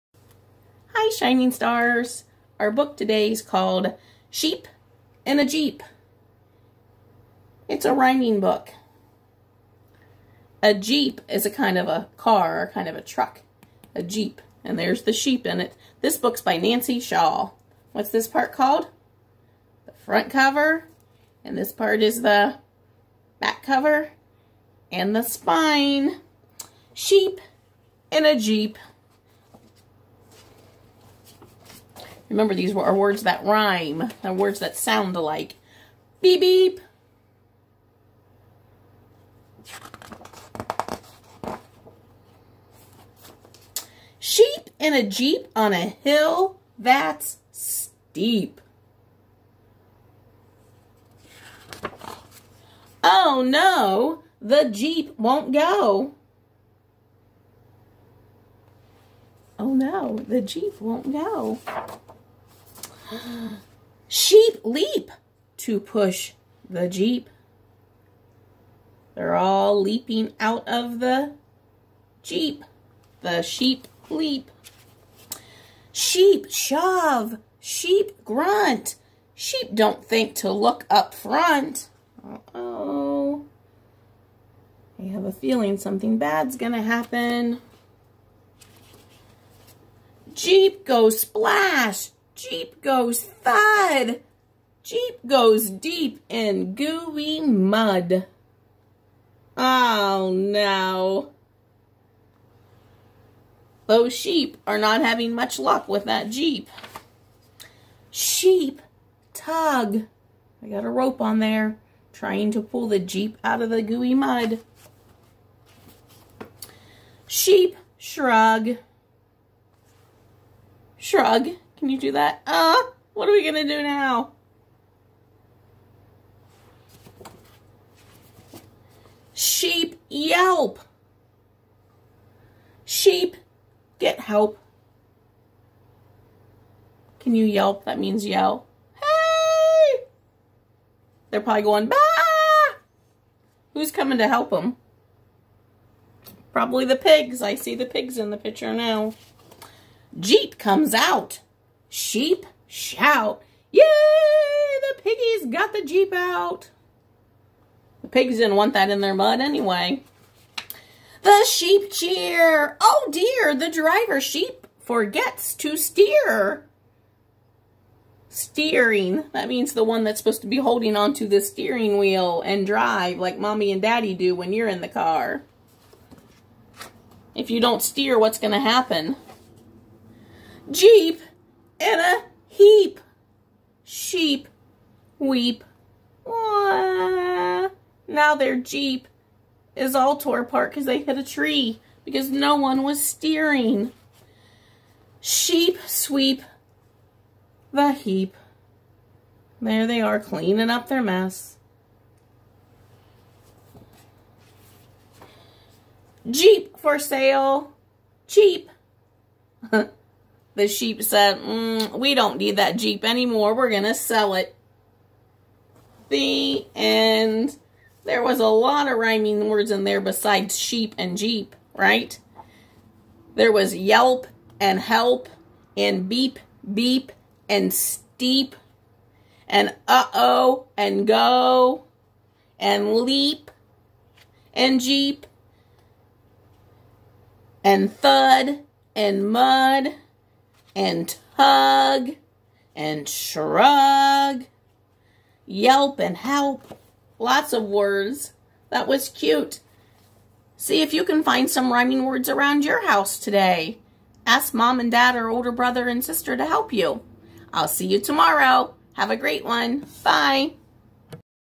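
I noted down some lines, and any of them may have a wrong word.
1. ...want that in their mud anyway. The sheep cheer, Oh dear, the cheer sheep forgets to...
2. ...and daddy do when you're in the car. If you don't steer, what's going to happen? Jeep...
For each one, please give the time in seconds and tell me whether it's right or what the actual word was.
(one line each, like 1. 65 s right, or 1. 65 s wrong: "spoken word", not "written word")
1. 158 s wrong: "driver", not "cheer"
2. 173 s right.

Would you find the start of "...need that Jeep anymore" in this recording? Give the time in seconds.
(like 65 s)
212 s.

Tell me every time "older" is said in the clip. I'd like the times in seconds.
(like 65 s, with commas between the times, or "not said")
255 s.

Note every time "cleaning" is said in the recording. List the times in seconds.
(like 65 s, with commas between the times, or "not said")
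200 s.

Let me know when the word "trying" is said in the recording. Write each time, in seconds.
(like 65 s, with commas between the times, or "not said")
112 s.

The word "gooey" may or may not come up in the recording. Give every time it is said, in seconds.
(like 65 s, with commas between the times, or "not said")
96 s, 113 s.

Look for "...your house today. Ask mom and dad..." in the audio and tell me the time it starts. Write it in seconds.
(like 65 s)
252 s.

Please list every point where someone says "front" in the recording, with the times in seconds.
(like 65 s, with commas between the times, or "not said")
19 s, 81 s.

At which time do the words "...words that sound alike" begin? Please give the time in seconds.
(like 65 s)
34 s.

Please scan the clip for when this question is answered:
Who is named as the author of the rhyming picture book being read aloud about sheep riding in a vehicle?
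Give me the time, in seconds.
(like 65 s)
16 s.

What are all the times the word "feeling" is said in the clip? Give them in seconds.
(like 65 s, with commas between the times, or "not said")
85 s.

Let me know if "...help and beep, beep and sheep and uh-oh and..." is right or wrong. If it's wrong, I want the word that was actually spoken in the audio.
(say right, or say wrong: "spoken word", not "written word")
wrong: "steep", not "sheep".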